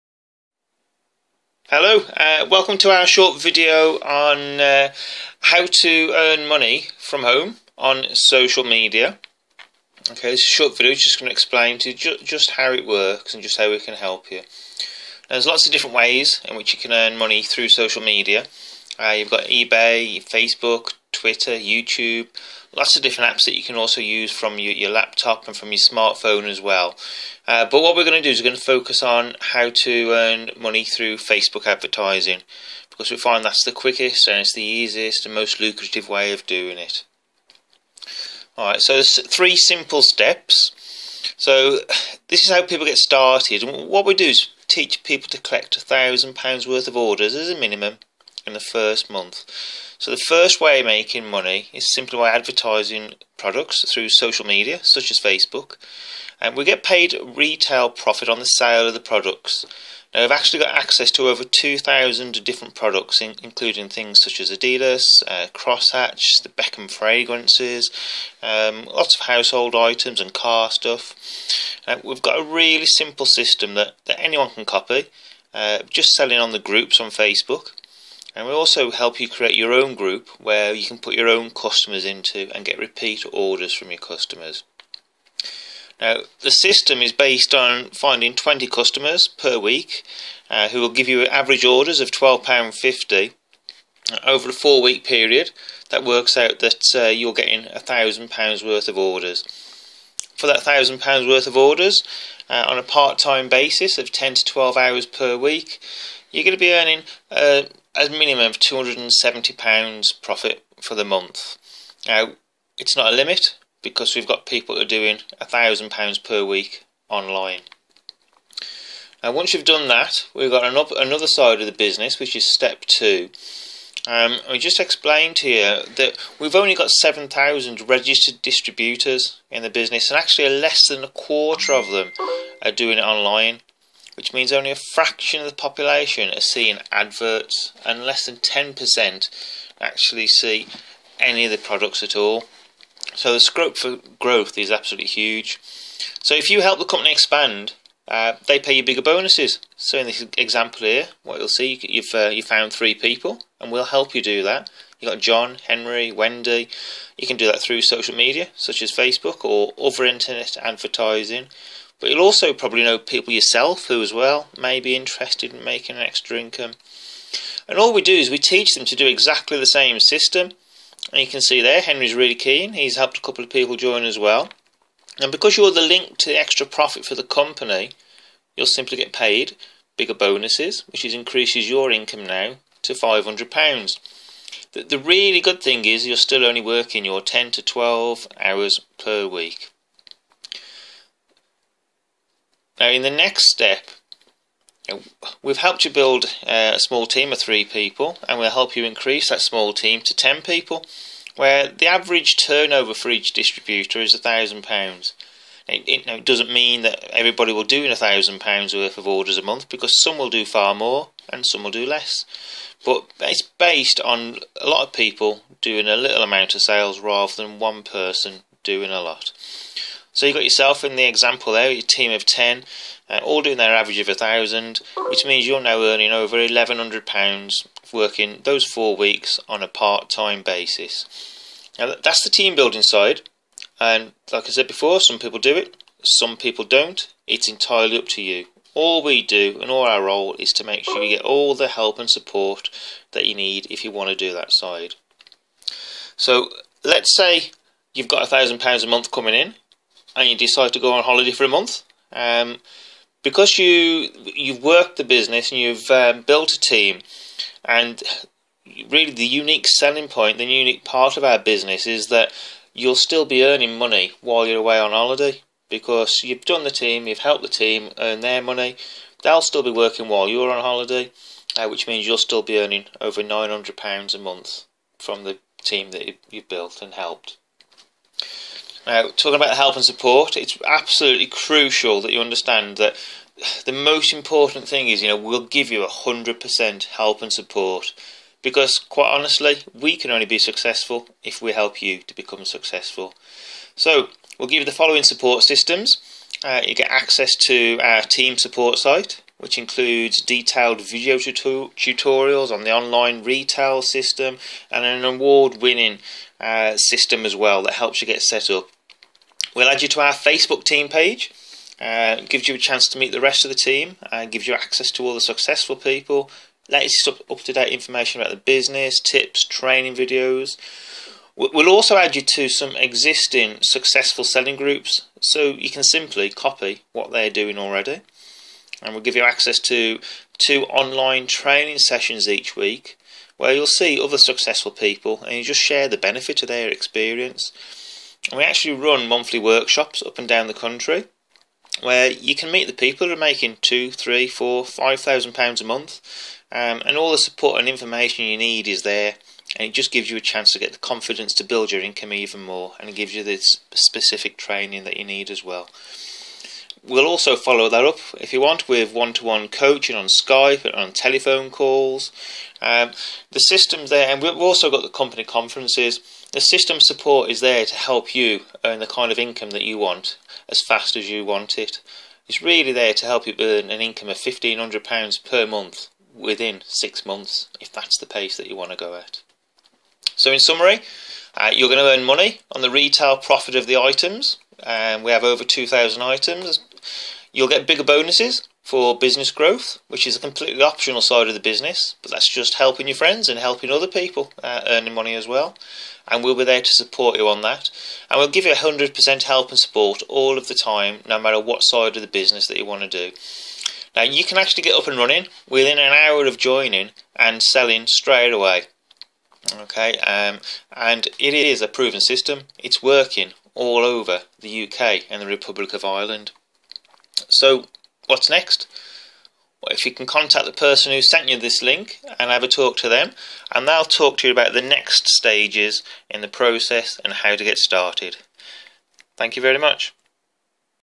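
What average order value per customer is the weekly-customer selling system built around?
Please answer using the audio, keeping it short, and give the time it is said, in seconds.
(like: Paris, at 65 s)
£12.50, at 92 s.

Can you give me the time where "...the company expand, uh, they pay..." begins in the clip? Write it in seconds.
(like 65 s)
146 s.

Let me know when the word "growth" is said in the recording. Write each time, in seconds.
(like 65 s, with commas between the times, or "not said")
144 s, 389 s.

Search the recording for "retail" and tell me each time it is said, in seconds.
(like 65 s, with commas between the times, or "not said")
57 s, 303 s, 382 s.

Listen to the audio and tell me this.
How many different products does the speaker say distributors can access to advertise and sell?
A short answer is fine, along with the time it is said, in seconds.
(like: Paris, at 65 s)
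2,000, at 61 s.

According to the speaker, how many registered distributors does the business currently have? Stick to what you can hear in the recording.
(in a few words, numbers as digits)
7,000.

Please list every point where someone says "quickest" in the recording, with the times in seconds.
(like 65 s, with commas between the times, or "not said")
33 s.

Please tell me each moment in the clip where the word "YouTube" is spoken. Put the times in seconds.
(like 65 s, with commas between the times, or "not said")
21 s.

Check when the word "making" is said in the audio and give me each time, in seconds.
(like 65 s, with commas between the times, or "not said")
50 s, 165 s, 343 s.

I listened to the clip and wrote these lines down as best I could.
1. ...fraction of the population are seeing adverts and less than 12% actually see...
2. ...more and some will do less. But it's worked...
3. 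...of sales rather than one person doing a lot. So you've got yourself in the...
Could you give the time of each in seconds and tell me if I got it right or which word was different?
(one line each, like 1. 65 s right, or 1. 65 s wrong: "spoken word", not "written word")
1. 134 s wrong: "10", not "12"
2. 210 s wrong: "based", not "worked"
3. 216 s right.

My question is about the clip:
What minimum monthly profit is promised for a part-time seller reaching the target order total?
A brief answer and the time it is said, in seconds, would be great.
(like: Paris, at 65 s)
£270, at 108 s.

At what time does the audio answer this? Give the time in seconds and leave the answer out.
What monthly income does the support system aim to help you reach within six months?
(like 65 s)
374 s.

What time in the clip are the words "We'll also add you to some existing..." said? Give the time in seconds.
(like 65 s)
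321 s.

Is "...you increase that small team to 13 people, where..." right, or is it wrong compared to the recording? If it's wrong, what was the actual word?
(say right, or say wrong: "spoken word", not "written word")
wrong: "10", not "13".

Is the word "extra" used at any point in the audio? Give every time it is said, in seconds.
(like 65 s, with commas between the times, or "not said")
166 s, 176 s.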